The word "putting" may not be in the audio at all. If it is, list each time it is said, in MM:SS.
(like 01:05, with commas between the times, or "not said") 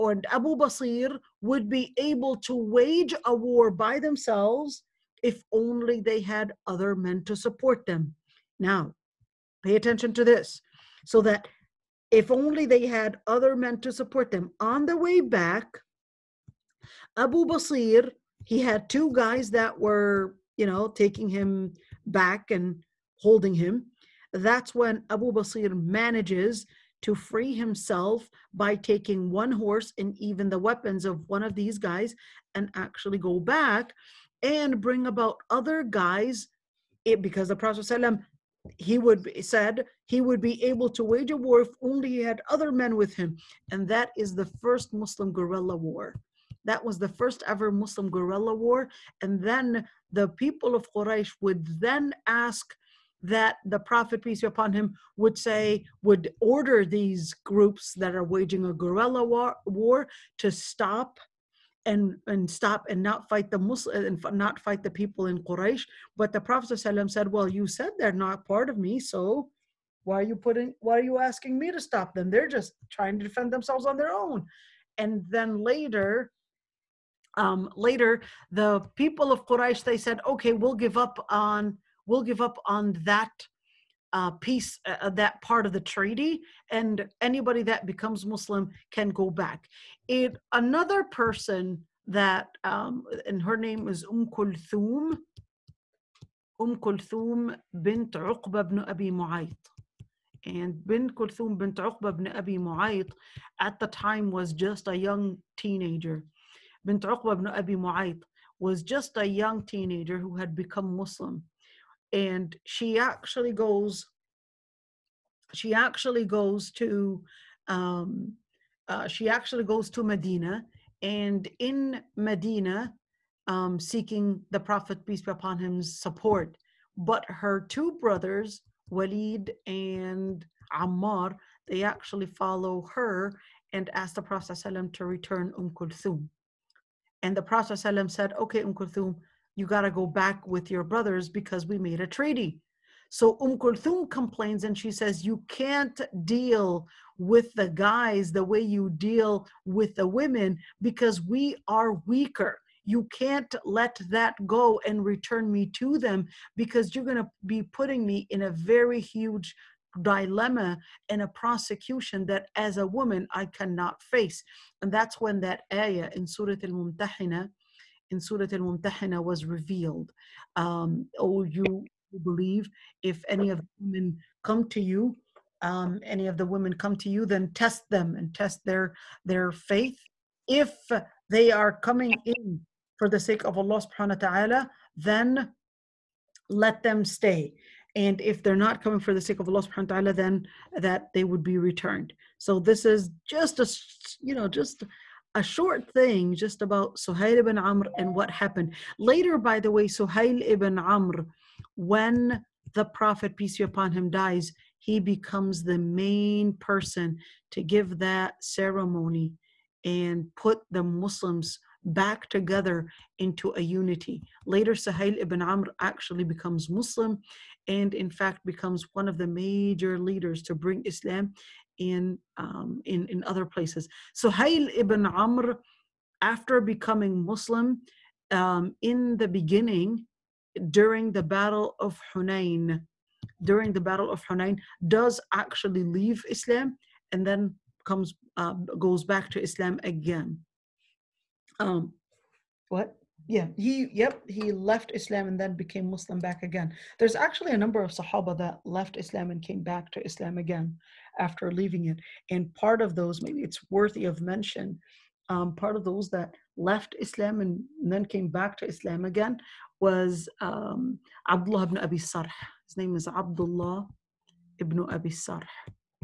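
01:10, 02:37.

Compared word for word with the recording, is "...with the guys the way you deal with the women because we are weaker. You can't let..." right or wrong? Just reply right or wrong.
right.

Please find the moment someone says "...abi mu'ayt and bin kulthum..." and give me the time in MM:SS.
01:38.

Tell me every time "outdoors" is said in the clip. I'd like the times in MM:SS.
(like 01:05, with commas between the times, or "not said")
not said.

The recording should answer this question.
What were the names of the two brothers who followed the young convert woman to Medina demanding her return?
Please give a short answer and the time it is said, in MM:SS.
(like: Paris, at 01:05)
Walid and Ammar, at 02:08.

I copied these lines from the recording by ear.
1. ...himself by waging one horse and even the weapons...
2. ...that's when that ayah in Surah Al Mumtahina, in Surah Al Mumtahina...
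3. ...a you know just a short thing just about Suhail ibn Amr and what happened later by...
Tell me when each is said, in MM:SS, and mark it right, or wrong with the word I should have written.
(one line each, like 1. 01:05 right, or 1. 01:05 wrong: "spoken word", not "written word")
1. 00:27 wrong: "taking", not "waging"
2. 02:44 right
3. 03:13 right.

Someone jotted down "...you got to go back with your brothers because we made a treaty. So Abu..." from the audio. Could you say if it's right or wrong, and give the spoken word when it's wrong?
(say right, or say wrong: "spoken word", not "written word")
wrong: "Umm", not "Abu".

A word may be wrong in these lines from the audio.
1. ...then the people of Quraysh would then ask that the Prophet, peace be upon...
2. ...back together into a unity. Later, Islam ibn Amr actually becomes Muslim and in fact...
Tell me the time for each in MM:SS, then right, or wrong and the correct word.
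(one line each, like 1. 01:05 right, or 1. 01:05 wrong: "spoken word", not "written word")
1. 00:49 right
2. 03:31 wrong: "Suhail", not "Islam".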